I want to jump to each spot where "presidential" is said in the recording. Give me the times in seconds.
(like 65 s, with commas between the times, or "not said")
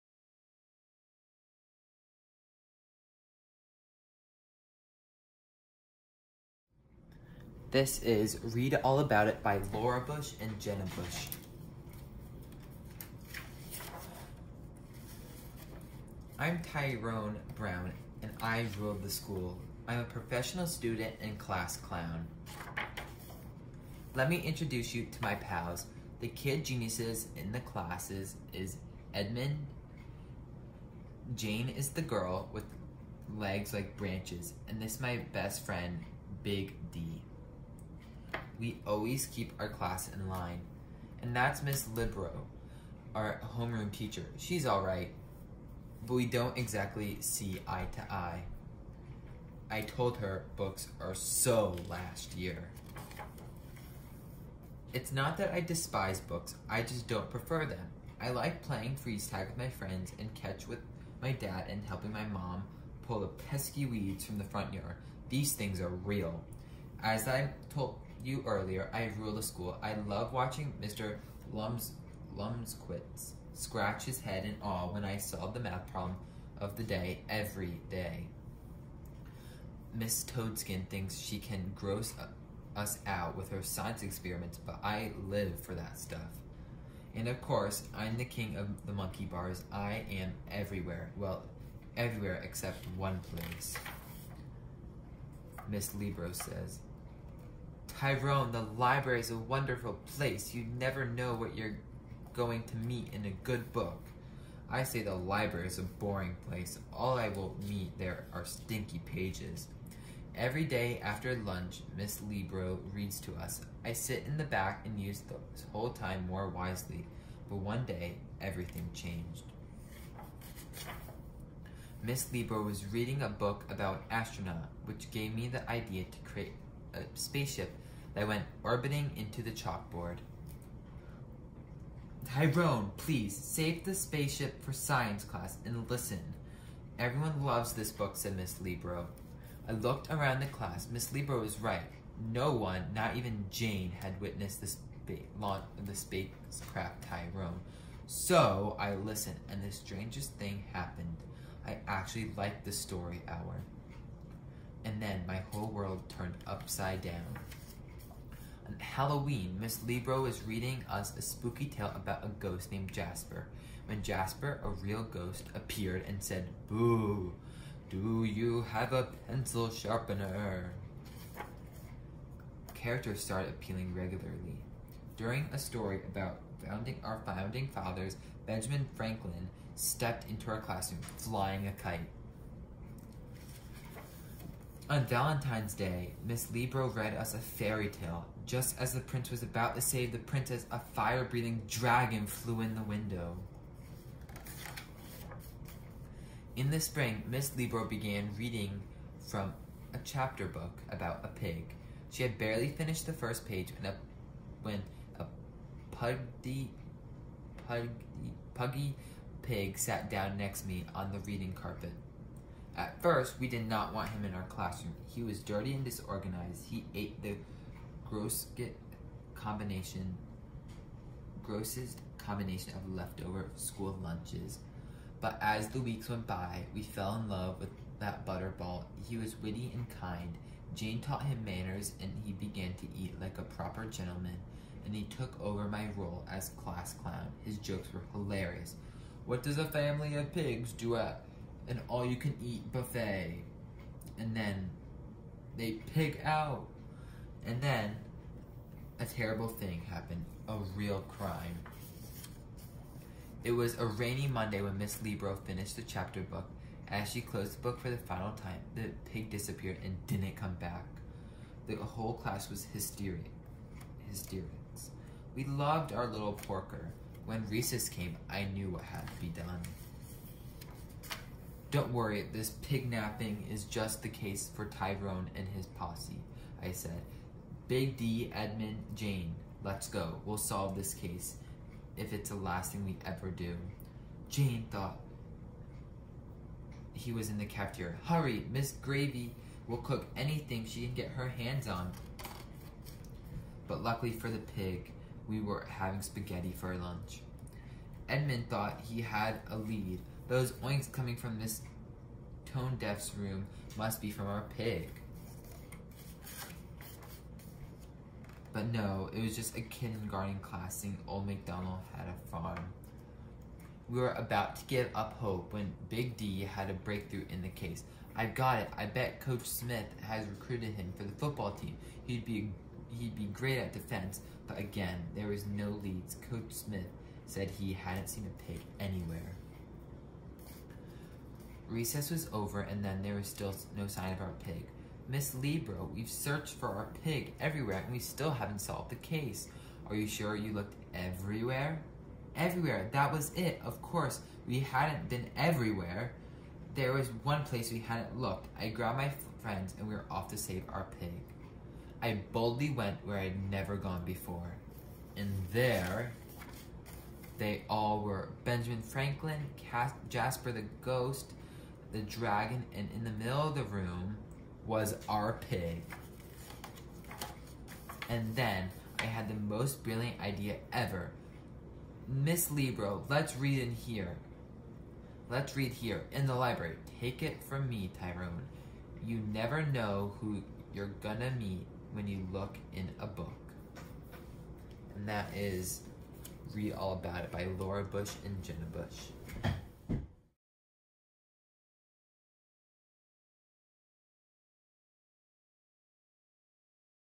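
not said.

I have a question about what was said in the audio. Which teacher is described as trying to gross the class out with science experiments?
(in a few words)
Miss Toadskin.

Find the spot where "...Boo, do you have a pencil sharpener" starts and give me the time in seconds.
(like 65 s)
166 s.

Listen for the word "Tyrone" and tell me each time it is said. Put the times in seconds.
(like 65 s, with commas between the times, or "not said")
16 s, 97 s, 132 s, 147 s, 274 s, 377 s.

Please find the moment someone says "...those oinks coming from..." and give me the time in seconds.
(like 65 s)
300 s.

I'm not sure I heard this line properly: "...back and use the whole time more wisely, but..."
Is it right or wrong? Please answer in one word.
right.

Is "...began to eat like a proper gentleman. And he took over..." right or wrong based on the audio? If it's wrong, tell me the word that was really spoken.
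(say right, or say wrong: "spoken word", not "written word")
right.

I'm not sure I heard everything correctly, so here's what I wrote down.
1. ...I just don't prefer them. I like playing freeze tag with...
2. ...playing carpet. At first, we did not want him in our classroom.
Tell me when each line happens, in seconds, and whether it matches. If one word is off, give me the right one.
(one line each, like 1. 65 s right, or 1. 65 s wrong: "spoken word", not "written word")
1. 56 s right
2. 211 s wrong: "reading", not "playing".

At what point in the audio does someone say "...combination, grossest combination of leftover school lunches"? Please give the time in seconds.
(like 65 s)
219 s.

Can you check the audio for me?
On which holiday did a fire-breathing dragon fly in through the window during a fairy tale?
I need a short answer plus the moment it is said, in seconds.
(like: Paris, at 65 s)
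Valentine's Day, at 185 s.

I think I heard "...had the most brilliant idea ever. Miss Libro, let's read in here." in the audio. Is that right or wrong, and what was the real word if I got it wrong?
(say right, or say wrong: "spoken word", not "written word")
right.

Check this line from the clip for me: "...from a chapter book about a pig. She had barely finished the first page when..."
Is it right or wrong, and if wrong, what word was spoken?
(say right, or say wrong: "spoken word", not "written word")
right.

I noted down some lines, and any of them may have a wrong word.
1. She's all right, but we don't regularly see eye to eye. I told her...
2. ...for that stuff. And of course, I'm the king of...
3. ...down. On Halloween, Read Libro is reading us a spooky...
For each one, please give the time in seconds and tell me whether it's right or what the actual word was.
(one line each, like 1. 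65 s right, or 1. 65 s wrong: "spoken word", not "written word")
1. 44 s wrong: "exactly", not "regularly"
2. 85 s right
3. 157 s wrong: "Miss", not "Read".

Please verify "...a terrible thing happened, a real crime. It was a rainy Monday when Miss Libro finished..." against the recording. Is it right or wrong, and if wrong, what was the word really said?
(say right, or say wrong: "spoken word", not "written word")
right.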